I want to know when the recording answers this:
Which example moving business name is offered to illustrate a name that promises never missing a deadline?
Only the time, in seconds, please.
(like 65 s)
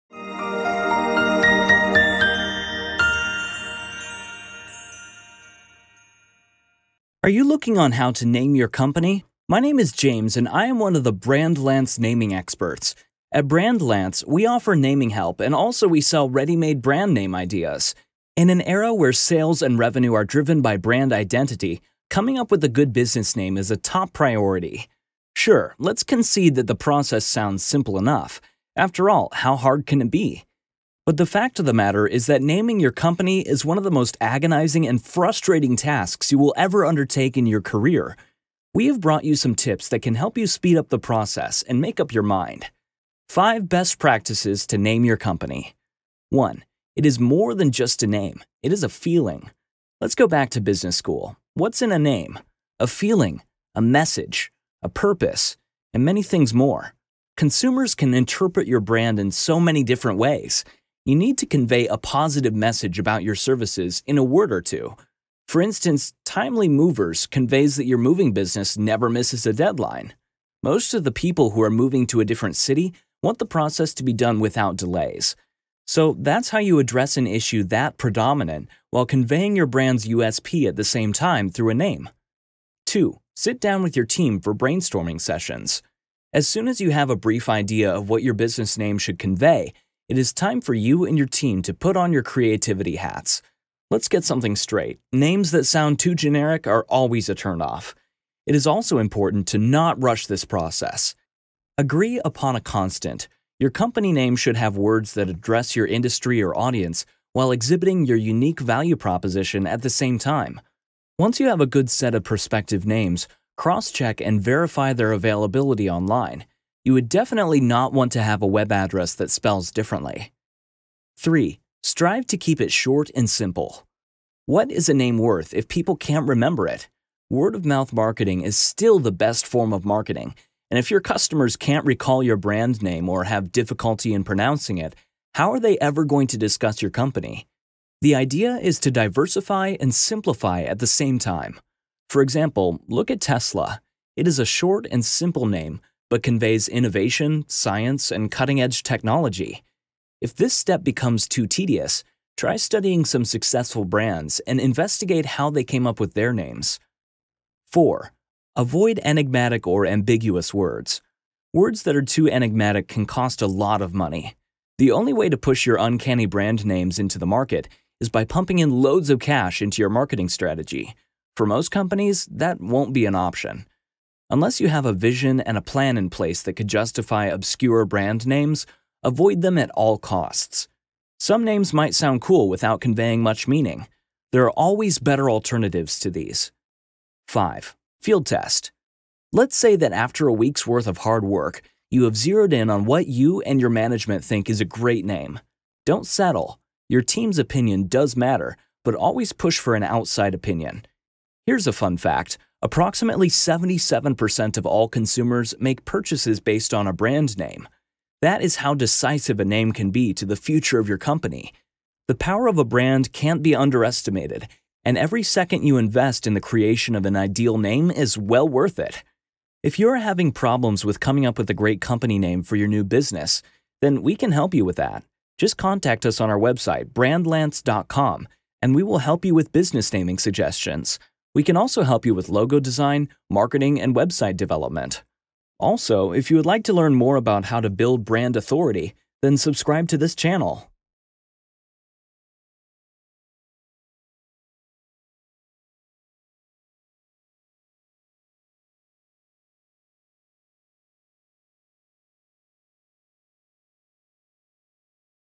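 66 s.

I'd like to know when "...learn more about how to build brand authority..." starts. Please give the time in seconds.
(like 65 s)
236 s.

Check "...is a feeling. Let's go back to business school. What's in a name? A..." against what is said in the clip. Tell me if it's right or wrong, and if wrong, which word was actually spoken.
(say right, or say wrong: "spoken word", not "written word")
right.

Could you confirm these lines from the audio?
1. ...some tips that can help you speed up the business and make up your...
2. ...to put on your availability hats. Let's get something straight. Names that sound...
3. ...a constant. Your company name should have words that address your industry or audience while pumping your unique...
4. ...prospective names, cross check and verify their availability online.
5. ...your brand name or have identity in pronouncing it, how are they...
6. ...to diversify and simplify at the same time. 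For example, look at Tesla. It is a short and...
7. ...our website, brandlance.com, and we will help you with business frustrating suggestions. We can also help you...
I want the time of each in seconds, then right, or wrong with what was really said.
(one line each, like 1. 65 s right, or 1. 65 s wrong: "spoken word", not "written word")
1. 39 s wrong: "process", not "business"
2. 91 s wrong: "creativity", not "availability"
3. 102 s wrong: "exhibiting", not "pumping"
4. 112 s right
5. 132 s wrong: "difficulty", not "identity"
6. 138 s right
7. 226 s wrong: "naming", not "frustrating".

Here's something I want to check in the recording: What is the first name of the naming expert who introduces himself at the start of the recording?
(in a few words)
James.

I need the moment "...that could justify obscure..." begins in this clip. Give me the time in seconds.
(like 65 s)
176 s.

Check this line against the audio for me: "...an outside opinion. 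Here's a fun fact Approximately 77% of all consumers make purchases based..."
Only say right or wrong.
right.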